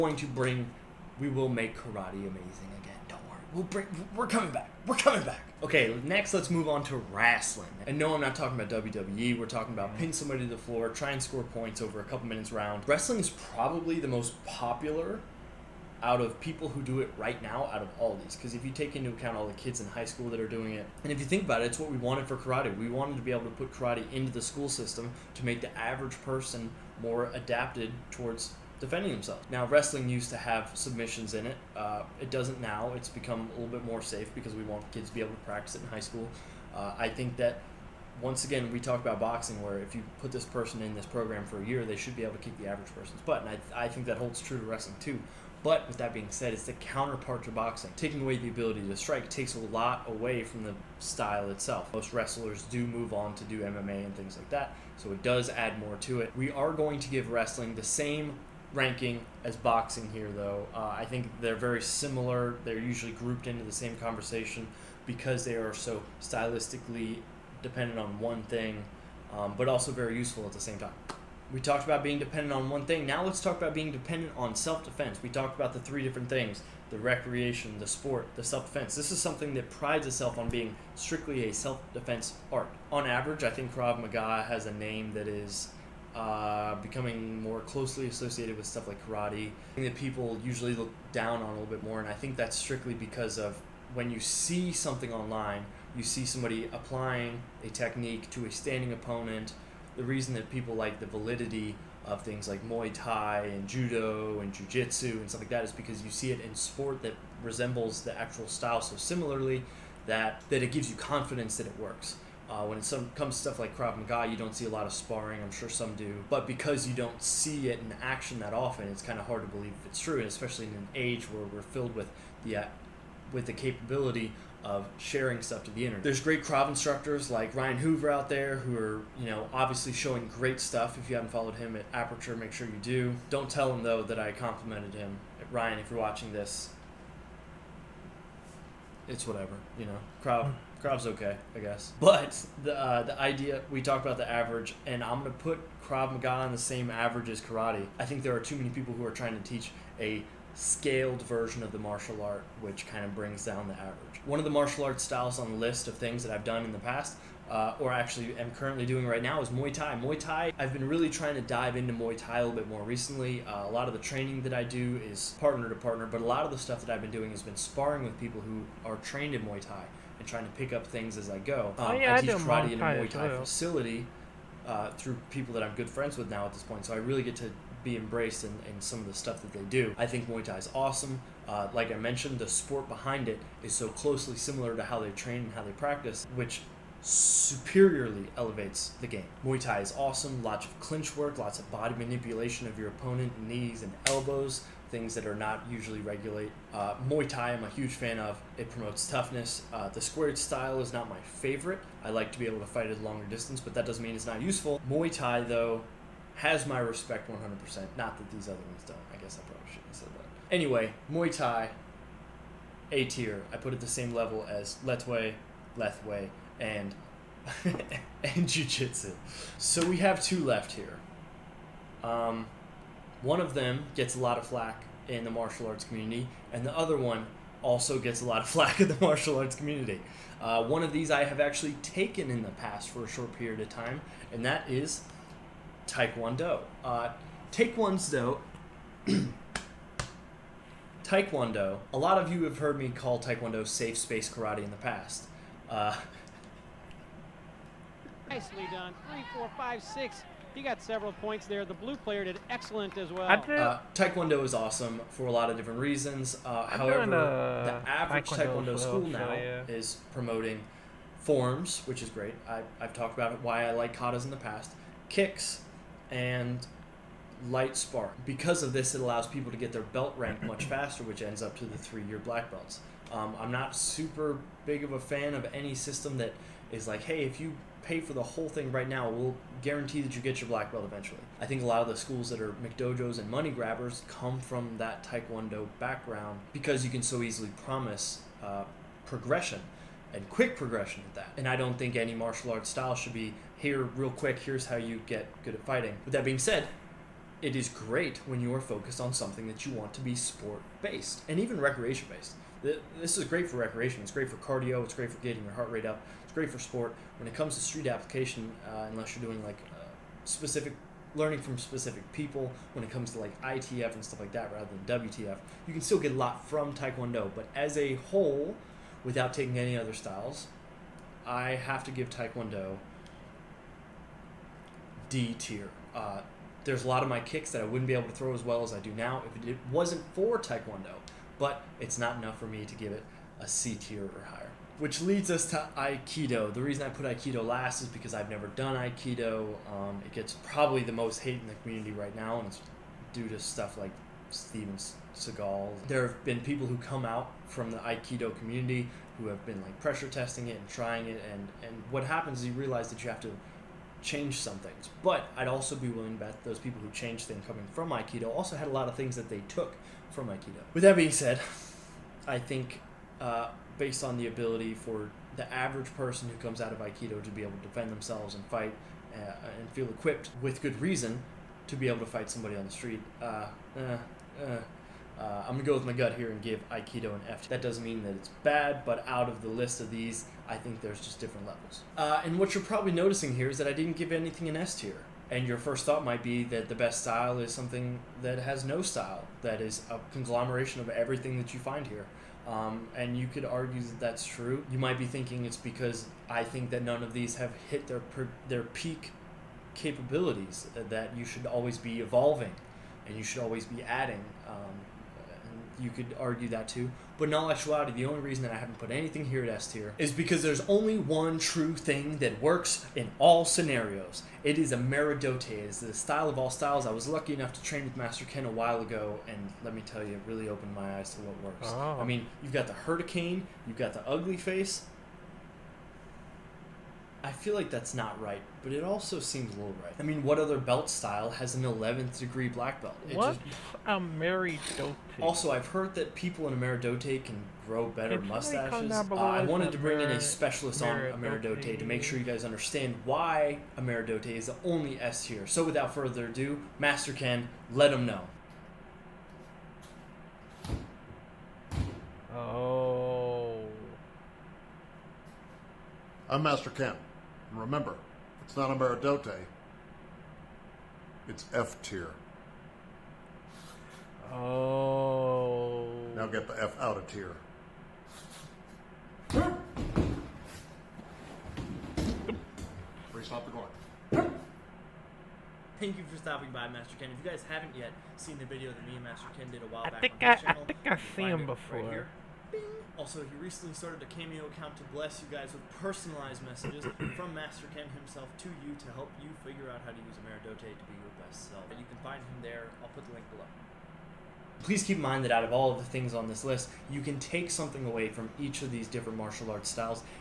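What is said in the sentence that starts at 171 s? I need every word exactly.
Oh, um, oh, yeah, I, I teach karate in a Muay Thai too.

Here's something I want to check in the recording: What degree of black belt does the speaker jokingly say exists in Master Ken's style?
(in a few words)
11th degree.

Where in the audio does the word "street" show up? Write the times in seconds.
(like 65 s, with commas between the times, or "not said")
307 s, 372 s.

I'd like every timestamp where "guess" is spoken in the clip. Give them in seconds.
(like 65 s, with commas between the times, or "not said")
141 s, 209 s.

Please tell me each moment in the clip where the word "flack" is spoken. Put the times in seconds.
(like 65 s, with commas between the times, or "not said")
224 s, 228 s.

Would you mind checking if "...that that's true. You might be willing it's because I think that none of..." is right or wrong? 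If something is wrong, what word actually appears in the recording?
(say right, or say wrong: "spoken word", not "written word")
wrong: "thinking", not "willing".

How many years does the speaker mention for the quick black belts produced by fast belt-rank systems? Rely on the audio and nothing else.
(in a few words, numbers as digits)
3.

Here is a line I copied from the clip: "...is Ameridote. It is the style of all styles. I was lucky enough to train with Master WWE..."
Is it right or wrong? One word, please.
wrong.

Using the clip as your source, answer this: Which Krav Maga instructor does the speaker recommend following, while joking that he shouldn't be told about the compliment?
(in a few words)
Ryan Hoover.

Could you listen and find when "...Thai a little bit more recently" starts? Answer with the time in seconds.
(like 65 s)
162 s.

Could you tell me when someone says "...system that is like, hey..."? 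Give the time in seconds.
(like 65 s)
275 s.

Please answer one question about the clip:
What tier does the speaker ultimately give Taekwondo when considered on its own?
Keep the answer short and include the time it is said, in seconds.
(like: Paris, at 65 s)
D tier, at 325 s.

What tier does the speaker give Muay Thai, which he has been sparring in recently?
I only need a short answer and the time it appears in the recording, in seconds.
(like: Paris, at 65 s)
A tier, at 212 s.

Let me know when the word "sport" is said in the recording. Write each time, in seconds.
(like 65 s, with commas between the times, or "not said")
77 s, 106 s, 182 s, 300 s, 306 s.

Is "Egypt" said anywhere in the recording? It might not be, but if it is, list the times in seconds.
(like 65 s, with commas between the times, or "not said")
not said.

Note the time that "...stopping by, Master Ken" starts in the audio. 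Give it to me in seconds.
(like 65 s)
476 s.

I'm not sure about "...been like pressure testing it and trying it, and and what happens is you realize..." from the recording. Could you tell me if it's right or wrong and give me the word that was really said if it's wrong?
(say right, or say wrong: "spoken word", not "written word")
right.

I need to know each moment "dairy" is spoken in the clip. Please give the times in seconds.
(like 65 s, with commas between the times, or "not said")
not said.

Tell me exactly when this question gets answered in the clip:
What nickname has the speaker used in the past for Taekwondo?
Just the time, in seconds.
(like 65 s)
243 s.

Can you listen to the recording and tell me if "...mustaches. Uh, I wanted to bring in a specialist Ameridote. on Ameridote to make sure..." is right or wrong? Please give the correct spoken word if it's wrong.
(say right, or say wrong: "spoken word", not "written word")
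right.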